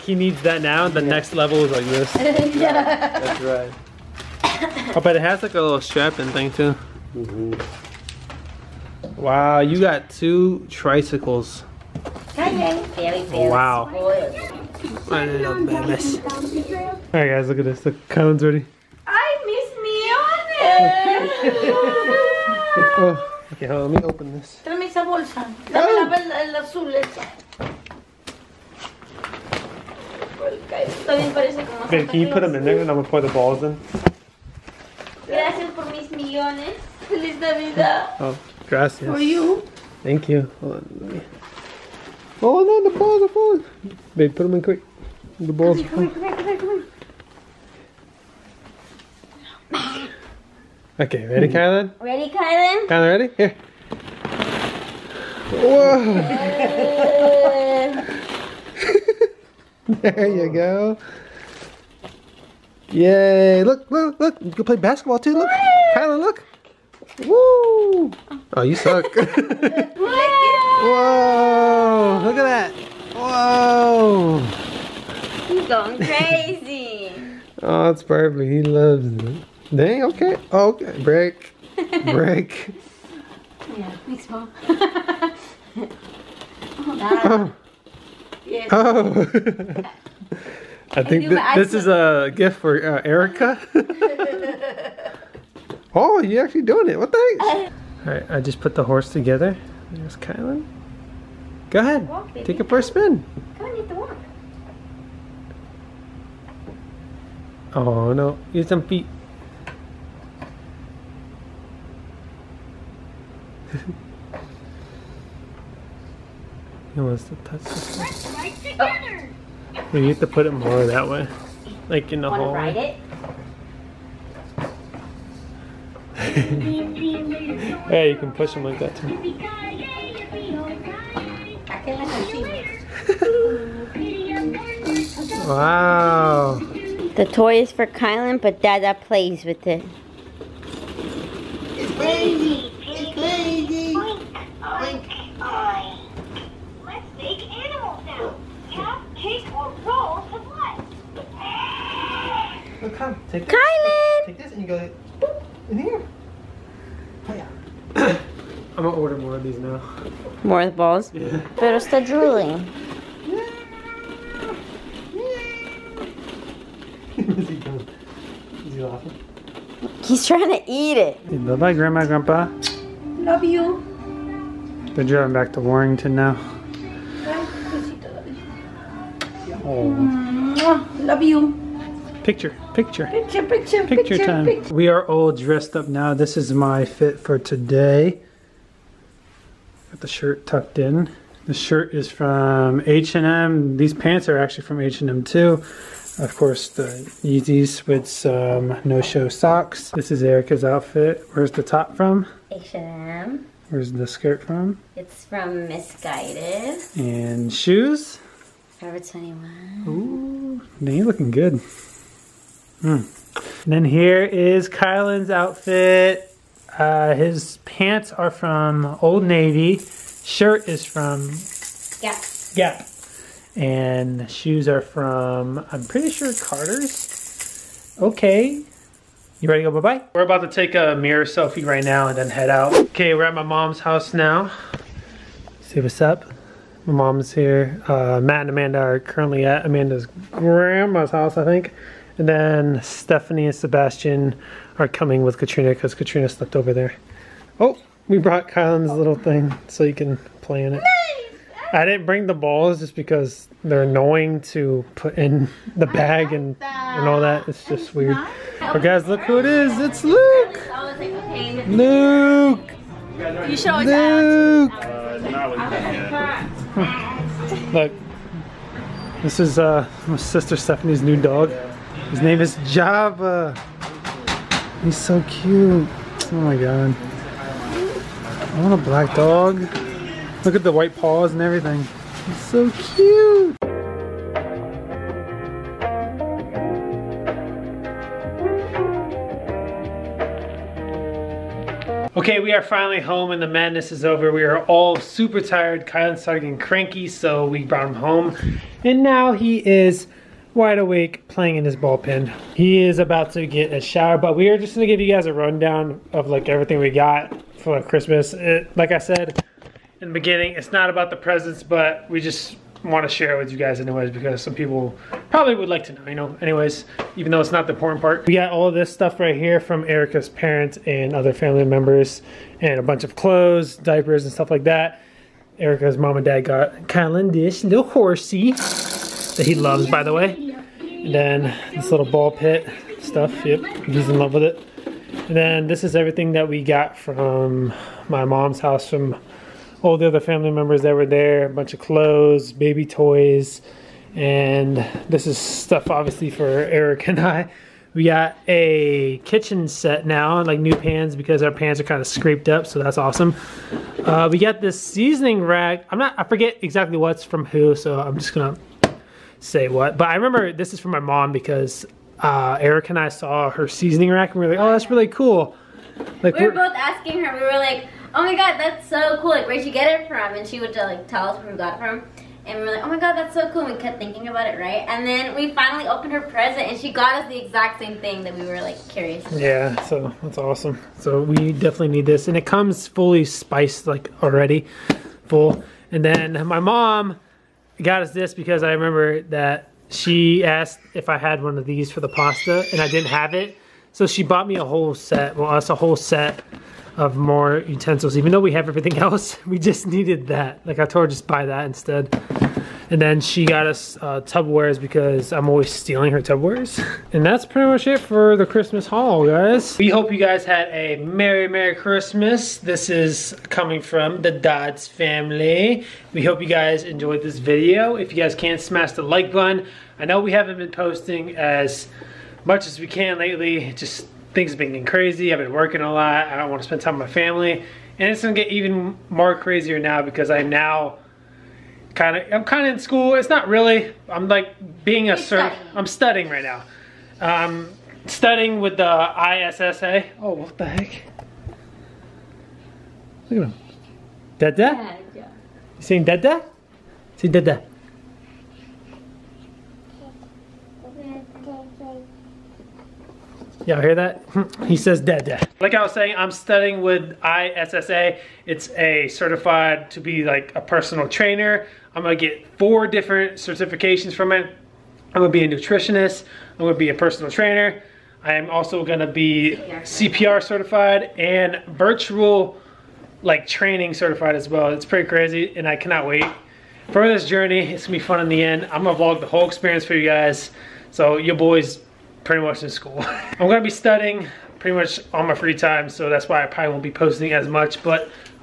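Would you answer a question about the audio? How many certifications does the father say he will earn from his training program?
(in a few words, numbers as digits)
4.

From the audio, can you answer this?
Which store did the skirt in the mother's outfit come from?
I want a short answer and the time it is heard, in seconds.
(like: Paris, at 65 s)
Missguided, at 205 s.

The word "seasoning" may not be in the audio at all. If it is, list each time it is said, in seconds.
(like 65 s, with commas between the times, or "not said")
354 s, 363 s.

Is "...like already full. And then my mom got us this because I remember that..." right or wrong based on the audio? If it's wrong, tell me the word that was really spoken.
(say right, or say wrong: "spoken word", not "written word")
right.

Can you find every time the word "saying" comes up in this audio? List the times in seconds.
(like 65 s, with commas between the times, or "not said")
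445 s, 455 s.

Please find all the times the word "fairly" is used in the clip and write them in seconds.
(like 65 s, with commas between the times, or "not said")
not said.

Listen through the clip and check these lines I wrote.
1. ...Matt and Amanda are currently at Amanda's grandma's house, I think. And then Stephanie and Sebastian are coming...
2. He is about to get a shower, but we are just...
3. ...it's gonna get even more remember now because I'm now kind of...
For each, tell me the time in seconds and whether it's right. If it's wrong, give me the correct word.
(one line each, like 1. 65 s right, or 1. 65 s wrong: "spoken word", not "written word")
1. 238 s right
2. 302 s right
3. 428 s wrong: "crazier", not "remember".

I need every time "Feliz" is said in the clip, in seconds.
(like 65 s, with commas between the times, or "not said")
37 s.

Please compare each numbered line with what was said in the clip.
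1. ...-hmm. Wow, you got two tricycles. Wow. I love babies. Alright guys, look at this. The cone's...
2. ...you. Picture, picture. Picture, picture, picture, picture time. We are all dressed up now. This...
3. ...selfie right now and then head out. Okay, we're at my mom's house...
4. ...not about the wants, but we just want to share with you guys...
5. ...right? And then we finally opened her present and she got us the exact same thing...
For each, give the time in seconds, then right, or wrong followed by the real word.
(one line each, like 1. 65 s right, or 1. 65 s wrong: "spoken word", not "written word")
1. 7 s right
2. 181 s right
3. 231 s right
4. 310 s wrong: "presents", not "wants"
5. 374 s right.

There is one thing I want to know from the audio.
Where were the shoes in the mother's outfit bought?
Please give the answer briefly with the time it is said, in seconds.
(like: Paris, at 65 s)
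Forever 21, at 208 s.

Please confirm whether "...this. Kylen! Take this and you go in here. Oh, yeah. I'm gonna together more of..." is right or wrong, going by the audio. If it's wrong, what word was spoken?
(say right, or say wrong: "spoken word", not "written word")
wrong: "order", not "together".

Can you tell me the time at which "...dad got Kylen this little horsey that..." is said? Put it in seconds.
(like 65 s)
326 s.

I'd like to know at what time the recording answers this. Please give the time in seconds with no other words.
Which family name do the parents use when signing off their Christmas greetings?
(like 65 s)
414 s.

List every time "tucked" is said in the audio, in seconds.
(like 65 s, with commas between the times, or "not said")
190 s.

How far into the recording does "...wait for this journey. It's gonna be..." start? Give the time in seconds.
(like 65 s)
476 s.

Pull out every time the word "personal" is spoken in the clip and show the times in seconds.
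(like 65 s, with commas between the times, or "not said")
460 s, 466 s.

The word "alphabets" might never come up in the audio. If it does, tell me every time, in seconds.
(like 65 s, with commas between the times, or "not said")
not said.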